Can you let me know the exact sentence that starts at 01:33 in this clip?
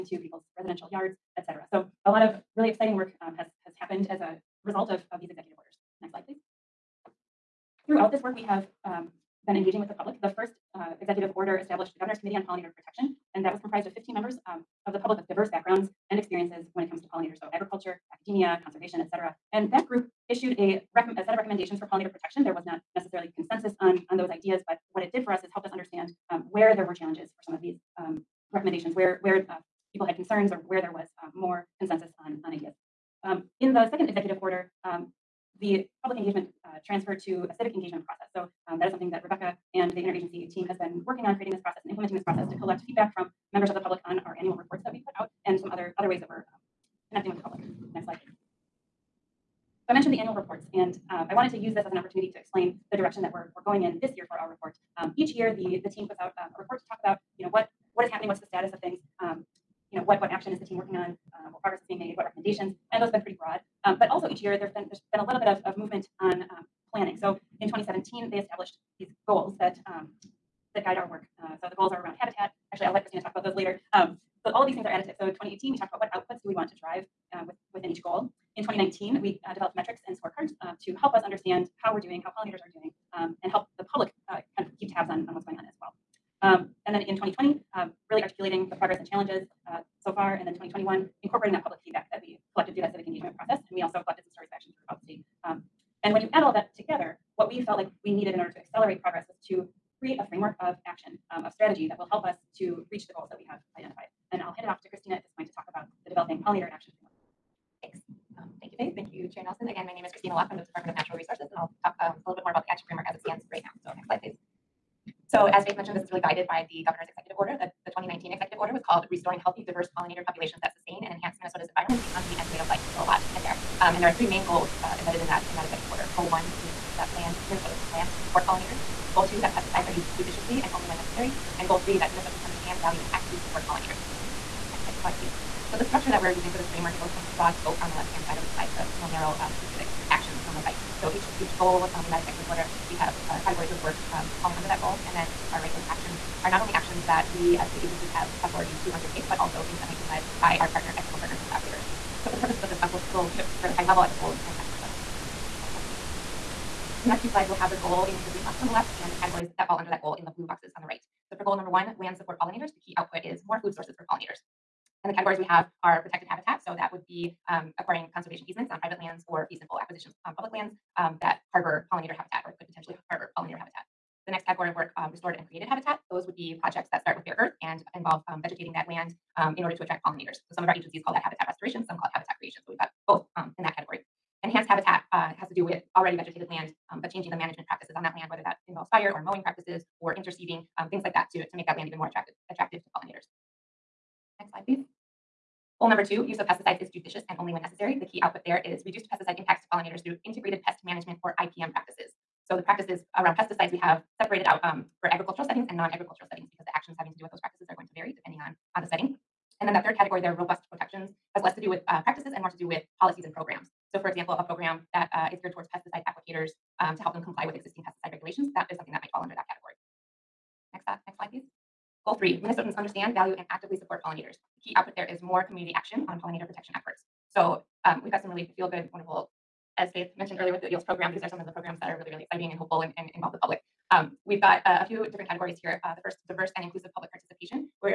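And we also collected some stories of action throughout the state.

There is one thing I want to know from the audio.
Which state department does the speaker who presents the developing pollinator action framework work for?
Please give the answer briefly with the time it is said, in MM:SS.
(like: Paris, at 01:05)
Department of Natural Resources, at 01:50.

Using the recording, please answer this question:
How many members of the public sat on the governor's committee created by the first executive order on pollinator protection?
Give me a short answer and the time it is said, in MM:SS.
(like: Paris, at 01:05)
15, at 00:13.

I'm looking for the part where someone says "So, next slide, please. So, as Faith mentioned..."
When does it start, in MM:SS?
01:53.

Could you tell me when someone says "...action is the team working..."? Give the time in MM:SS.
01:00.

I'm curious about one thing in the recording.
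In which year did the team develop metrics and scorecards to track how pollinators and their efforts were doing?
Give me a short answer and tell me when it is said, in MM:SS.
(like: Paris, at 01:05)
2019, at 01:18.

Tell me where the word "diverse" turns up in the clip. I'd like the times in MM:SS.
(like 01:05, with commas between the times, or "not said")
00:15, 01:59, 03:56.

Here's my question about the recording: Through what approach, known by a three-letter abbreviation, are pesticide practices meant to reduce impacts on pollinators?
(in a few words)
Integrated pest management.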